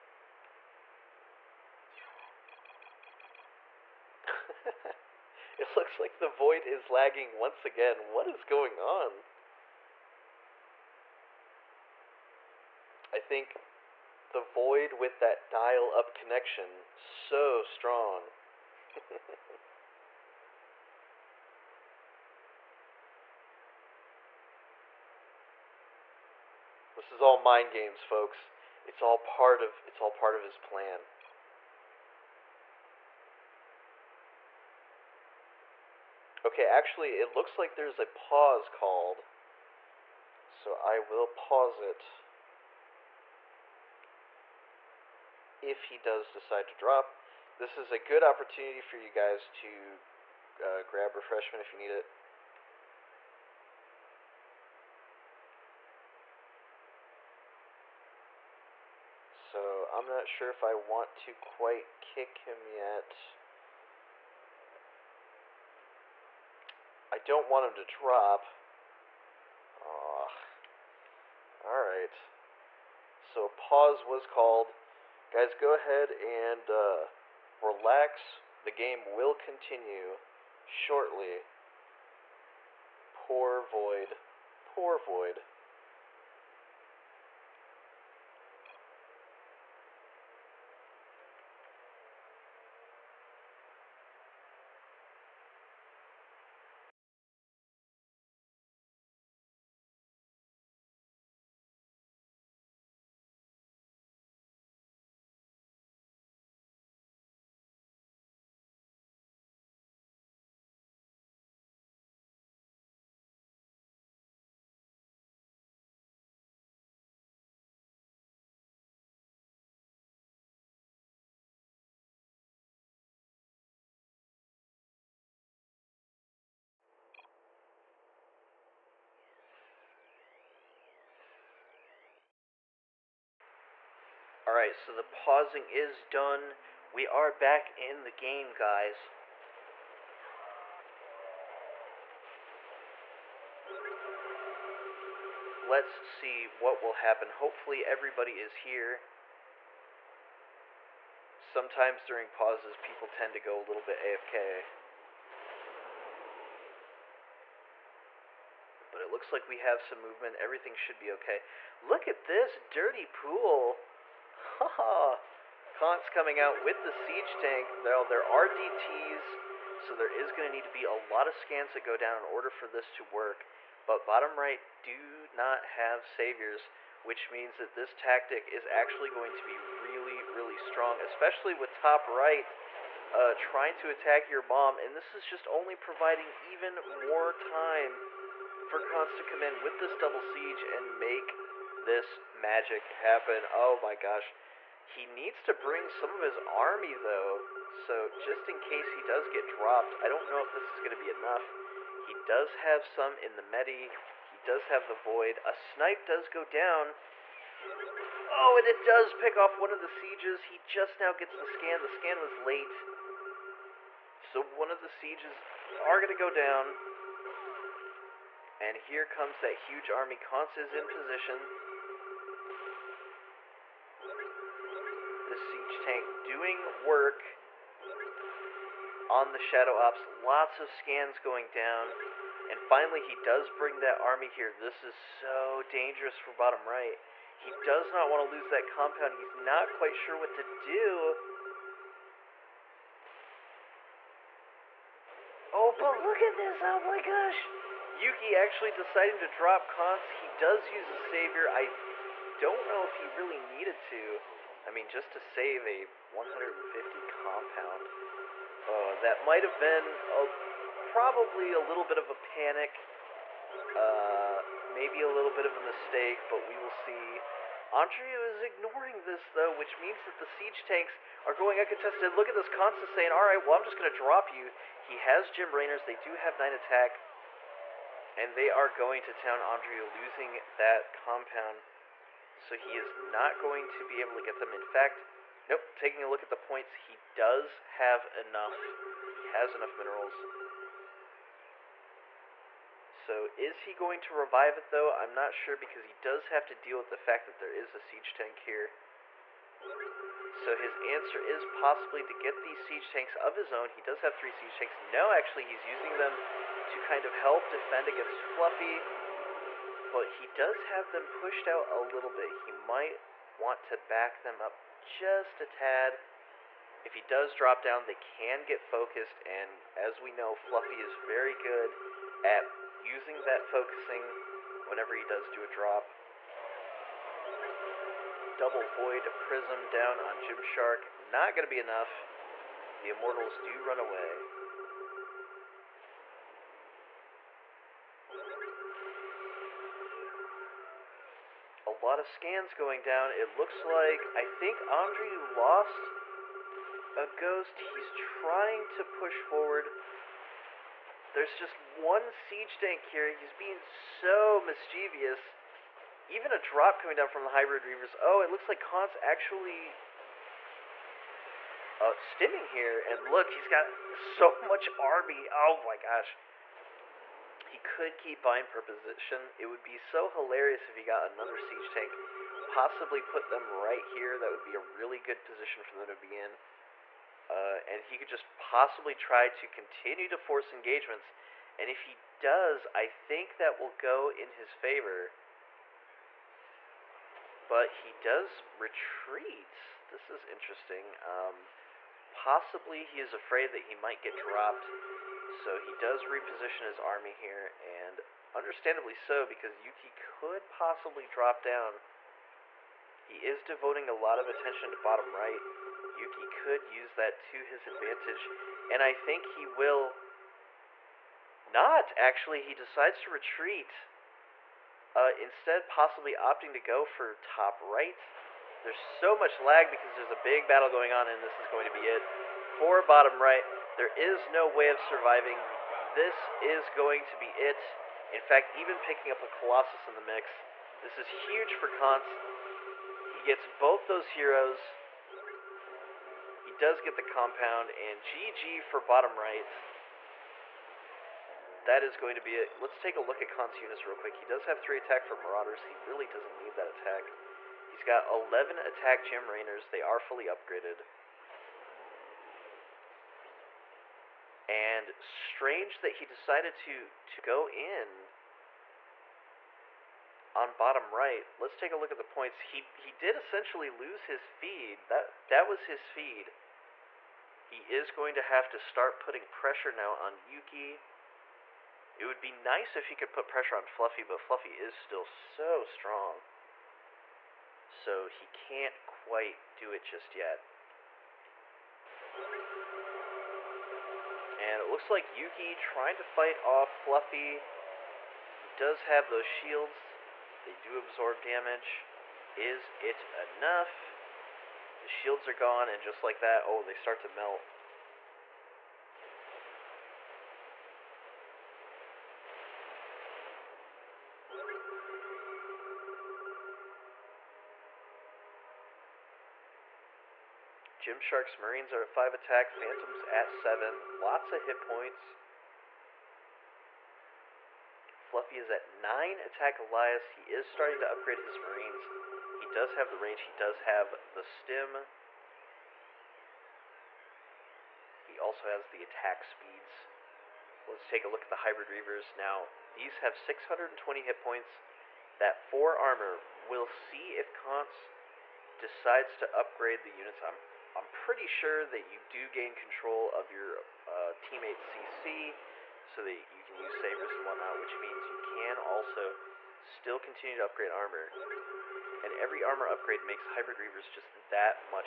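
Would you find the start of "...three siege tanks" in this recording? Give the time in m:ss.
5:04.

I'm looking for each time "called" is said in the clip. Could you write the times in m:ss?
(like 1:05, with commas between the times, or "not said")
0:38, 1:14.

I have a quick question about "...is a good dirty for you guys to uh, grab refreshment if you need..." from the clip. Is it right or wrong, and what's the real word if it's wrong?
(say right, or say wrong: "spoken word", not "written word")
wrong: "opportunity", not "dirty".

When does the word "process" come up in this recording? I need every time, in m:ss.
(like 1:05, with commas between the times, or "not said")
not said.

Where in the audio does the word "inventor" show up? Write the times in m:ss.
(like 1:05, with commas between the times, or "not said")
not said.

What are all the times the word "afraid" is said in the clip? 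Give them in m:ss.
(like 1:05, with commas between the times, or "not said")
6:33.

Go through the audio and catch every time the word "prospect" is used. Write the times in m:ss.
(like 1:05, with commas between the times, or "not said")
not said.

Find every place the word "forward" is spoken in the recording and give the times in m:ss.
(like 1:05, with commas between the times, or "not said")
5:49.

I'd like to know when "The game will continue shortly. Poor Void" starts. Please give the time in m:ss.
1:18.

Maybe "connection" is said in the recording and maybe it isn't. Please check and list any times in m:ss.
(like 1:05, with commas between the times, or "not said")
0:16.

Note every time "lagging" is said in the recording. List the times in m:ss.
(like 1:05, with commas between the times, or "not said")
0:06.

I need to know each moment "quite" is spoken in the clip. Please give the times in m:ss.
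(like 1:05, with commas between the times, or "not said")
1:01, 3:59, 7:59.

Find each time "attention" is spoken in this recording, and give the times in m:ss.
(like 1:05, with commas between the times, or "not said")
6:44.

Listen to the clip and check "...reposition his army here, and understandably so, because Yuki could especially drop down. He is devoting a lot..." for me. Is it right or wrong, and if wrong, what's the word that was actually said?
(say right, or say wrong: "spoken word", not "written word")
wrong: "possibly", not "especially".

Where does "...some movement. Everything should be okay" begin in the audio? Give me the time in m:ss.
2:39.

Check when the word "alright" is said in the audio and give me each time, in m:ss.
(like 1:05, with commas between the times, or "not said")
1:11, 2:14, 4:33.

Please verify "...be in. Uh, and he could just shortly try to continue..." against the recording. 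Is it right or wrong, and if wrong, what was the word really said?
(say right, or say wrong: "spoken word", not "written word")
wrong: "possibly", not "shortly".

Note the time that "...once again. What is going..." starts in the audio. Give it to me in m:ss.
0:07.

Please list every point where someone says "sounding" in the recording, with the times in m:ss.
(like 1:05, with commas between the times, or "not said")
not said.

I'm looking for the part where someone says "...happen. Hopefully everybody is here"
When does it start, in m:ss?
2:26.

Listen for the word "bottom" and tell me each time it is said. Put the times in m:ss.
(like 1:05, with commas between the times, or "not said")
2:54, 3:56, 6:44, 7:02, 7:18, 7:40.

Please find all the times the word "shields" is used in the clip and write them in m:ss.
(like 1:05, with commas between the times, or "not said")
8:09, 8:14.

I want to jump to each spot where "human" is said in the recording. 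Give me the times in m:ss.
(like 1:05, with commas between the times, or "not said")
not said.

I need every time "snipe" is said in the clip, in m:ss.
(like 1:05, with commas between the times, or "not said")
3:25.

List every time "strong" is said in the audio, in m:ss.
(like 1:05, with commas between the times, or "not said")
0:17, 3:00, 7:55.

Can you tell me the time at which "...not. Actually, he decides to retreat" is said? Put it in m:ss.
6:51.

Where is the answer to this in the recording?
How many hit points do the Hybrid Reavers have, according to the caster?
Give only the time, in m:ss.
8:53.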